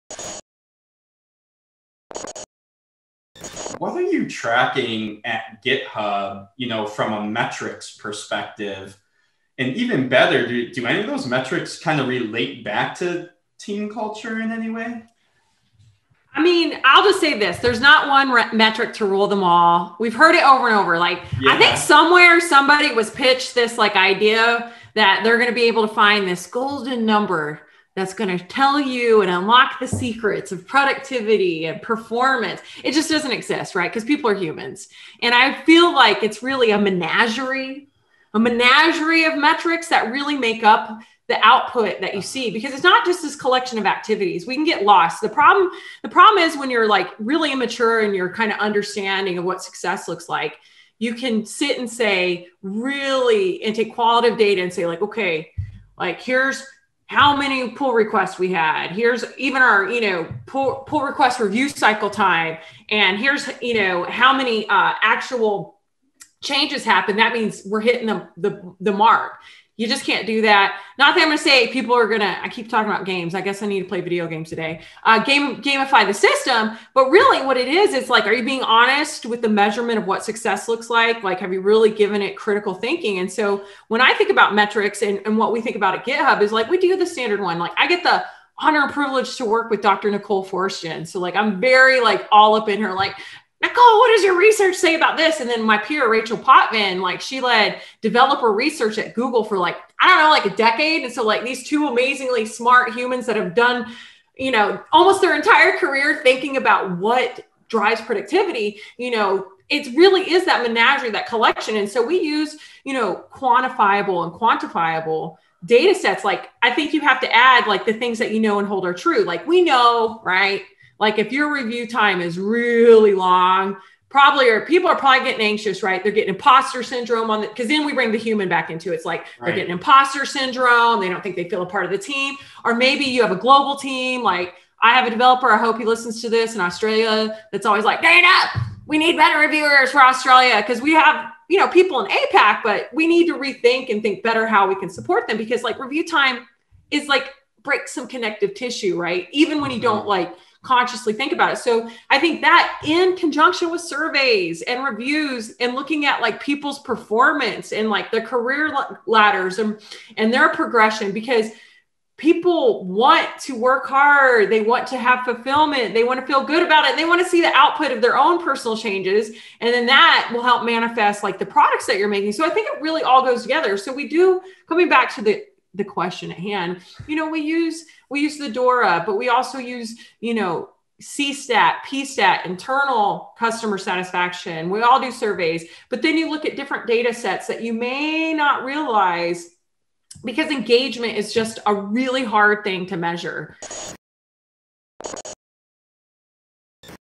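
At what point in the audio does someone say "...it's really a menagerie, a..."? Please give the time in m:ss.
0:36.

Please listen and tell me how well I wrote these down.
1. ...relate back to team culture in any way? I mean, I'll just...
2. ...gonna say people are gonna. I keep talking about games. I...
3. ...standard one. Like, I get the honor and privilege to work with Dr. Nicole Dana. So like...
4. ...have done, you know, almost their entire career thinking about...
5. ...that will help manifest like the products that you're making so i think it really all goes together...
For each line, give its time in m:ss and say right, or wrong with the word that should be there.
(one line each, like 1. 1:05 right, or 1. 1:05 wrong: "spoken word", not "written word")
1. 0:12 right
2. 1:11 right
3. 1:27 wrong: "Forsgren", not "Dana"
4. 1:43 right
5. 2:49 right.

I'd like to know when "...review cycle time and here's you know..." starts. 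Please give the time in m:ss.
1:01.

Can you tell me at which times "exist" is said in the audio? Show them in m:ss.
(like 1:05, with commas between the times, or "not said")
0:33.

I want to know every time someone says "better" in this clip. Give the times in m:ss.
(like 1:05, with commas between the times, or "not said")
0:10, 2:19, 2:24.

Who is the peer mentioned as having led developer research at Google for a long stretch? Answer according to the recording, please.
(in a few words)
Rachel Potvin.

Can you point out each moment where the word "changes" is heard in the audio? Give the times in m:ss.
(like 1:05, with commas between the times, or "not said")
1:06, 2:48.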